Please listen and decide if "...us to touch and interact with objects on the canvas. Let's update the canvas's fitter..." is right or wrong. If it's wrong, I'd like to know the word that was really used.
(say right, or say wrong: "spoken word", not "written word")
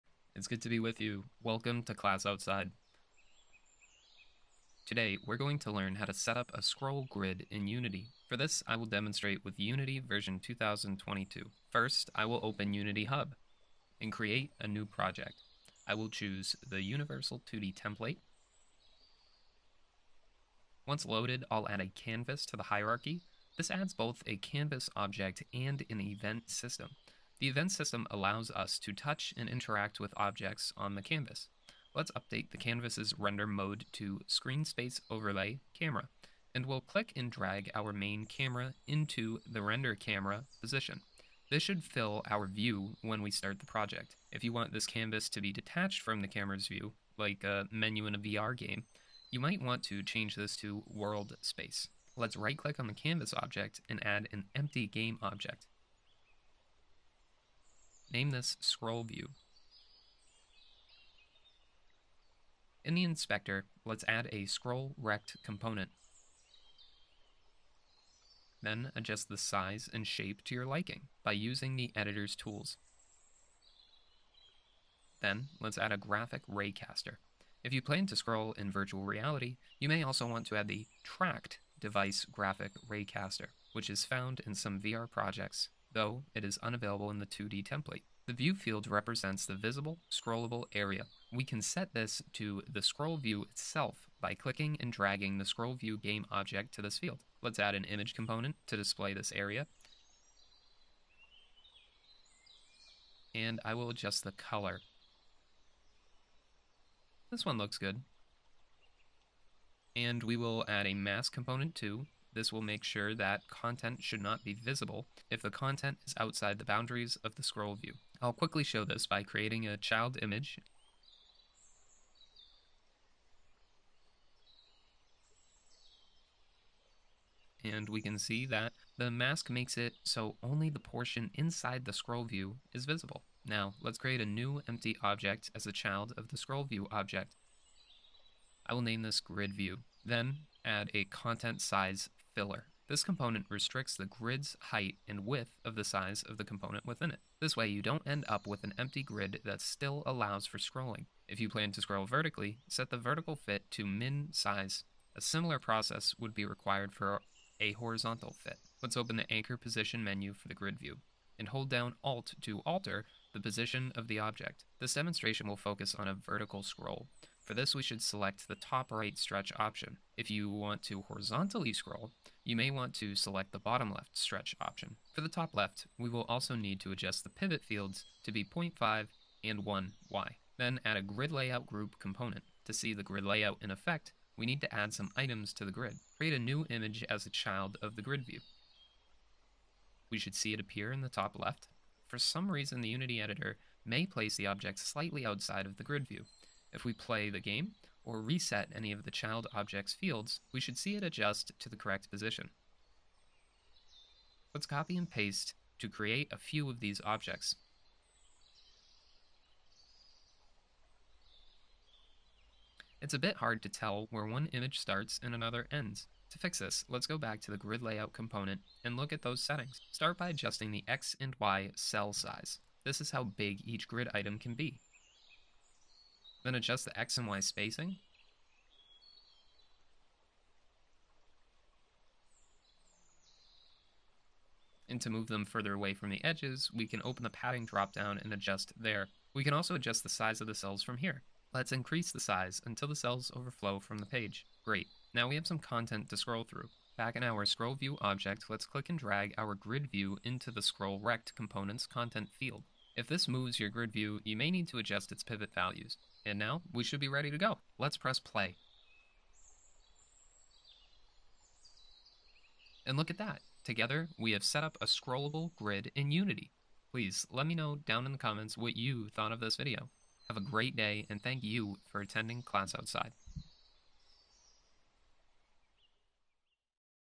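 wrong: "render", not "fitter".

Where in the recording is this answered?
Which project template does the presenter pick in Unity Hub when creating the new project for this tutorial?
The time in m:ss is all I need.
0:16.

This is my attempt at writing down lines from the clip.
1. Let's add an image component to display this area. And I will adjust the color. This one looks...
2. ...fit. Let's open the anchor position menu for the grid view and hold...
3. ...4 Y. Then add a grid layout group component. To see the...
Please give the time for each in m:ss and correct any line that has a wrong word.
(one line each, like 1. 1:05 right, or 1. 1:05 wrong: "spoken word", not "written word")
1. 1:37 right
2. 2:38 right
3. 2:59 wrong: "1", not "4".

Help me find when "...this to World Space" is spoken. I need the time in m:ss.
0:50.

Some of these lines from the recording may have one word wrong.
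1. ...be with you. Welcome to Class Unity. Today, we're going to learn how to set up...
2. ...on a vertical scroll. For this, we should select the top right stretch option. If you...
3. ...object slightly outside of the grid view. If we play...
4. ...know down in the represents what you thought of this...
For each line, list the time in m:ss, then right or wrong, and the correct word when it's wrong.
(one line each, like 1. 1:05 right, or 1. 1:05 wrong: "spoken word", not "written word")
1. 0:00 wrong: "Outside", not "Unity"
2. 2:45 right
3. 3:14 right
4. 4:27 wrong: "comments", not "represents".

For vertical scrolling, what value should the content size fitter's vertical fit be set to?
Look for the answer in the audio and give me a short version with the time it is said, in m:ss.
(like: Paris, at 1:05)
min size, at 2:33.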